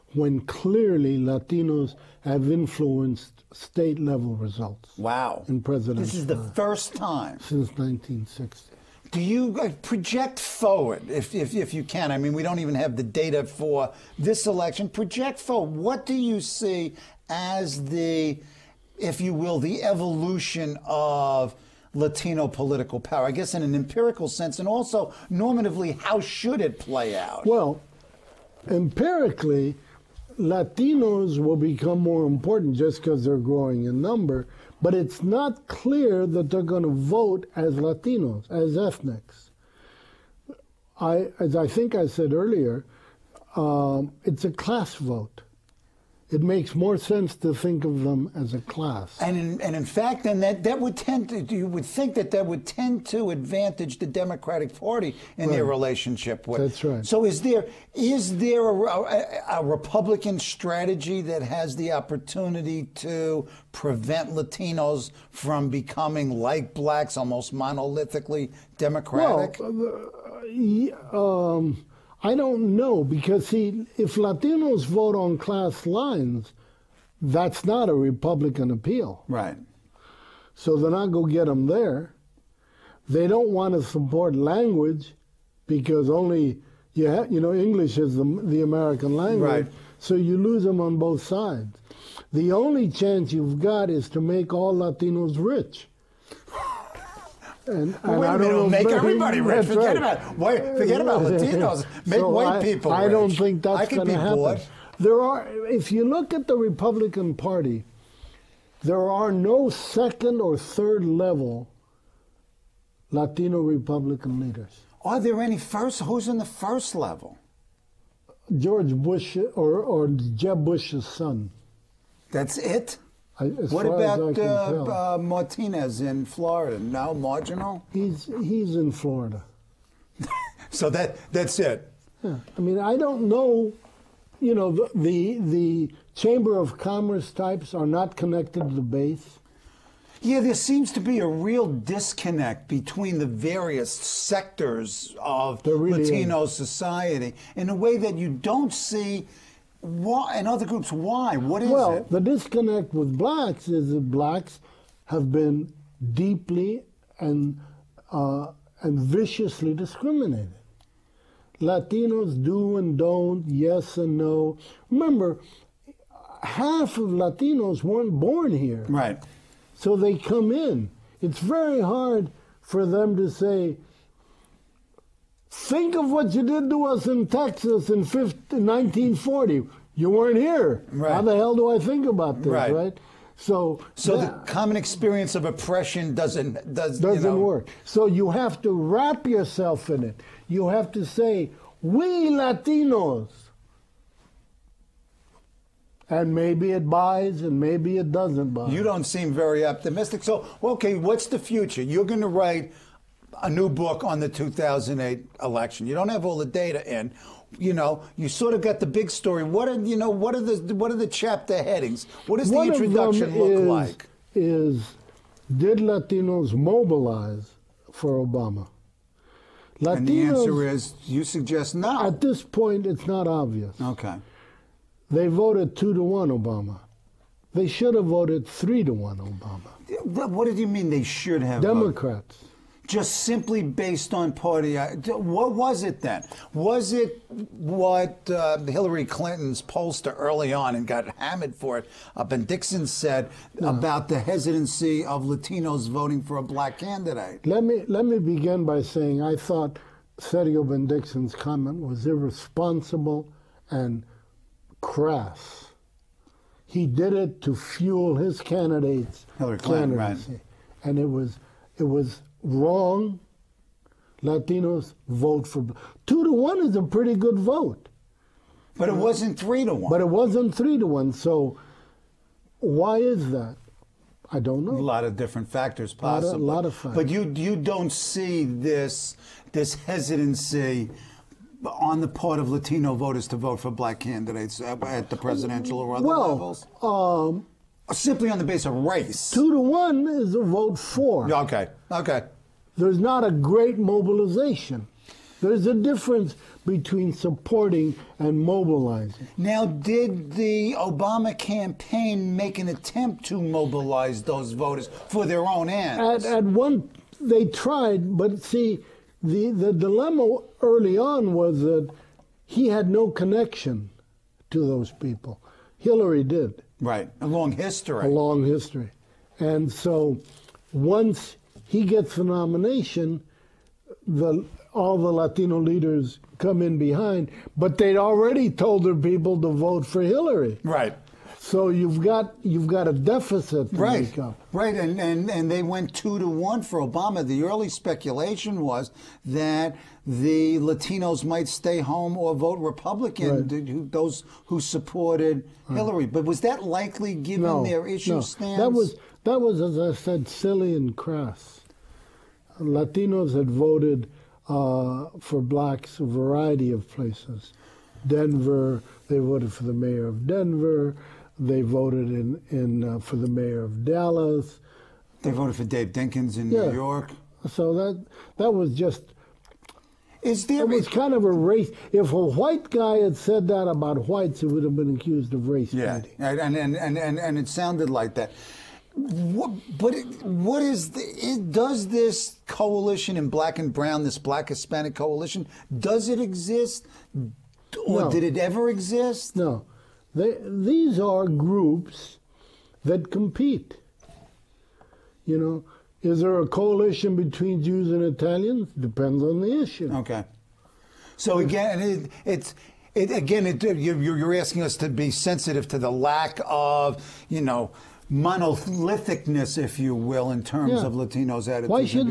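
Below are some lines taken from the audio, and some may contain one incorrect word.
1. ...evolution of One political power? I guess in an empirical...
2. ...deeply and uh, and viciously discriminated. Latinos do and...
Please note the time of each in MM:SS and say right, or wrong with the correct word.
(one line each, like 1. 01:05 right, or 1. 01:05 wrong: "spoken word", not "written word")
1. 00:19 wrong: "Latino", not "One"
2. 02:36 right.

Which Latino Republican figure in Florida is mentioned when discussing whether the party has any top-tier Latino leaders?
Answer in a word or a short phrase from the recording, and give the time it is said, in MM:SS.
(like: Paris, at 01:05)
Martinez, at 02:05.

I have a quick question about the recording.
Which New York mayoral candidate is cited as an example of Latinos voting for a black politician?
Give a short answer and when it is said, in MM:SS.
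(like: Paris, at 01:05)
Dave Dinkins, at 06:05.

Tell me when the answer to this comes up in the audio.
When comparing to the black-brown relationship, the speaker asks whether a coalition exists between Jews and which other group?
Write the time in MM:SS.
06:38.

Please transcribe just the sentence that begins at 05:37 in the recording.
The early speculation was that the Latinos might stay home or vote Republican, right.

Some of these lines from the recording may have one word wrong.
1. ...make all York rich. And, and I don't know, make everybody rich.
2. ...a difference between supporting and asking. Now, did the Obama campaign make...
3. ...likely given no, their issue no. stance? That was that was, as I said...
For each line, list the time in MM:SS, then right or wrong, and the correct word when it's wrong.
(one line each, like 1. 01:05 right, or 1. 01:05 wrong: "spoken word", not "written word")
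1. 01:34 wrong: "Latinos", not "York"
2. 04:55 wrong: "mobilizing", not "asking"
3. 05:46 right.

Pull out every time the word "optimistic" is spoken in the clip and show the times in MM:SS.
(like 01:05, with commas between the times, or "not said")
03:19.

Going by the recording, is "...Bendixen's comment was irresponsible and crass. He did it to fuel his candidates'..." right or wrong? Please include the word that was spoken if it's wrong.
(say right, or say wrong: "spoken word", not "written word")
right.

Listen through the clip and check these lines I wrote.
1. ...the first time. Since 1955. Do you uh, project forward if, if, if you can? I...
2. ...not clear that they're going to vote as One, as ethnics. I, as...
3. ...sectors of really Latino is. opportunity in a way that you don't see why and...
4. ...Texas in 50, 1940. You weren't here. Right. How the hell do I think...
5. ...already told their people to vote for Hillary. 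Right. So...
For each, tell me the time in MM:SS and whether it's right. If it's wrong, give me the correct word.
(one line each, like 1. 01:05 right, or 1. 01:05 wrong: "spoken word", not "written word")
1. 00:06 wrong: "1960", not "1955"
2. 00:35 wrong: "Latinos", not "One"
3. 02:23 wrong: "society", not "opportunity"
4. 02:57 right
5. 05:27 right.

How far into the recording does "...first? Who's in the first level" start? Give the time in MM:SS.
01:55.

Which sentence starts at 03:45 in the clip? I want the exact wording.
They voted two to one Obama.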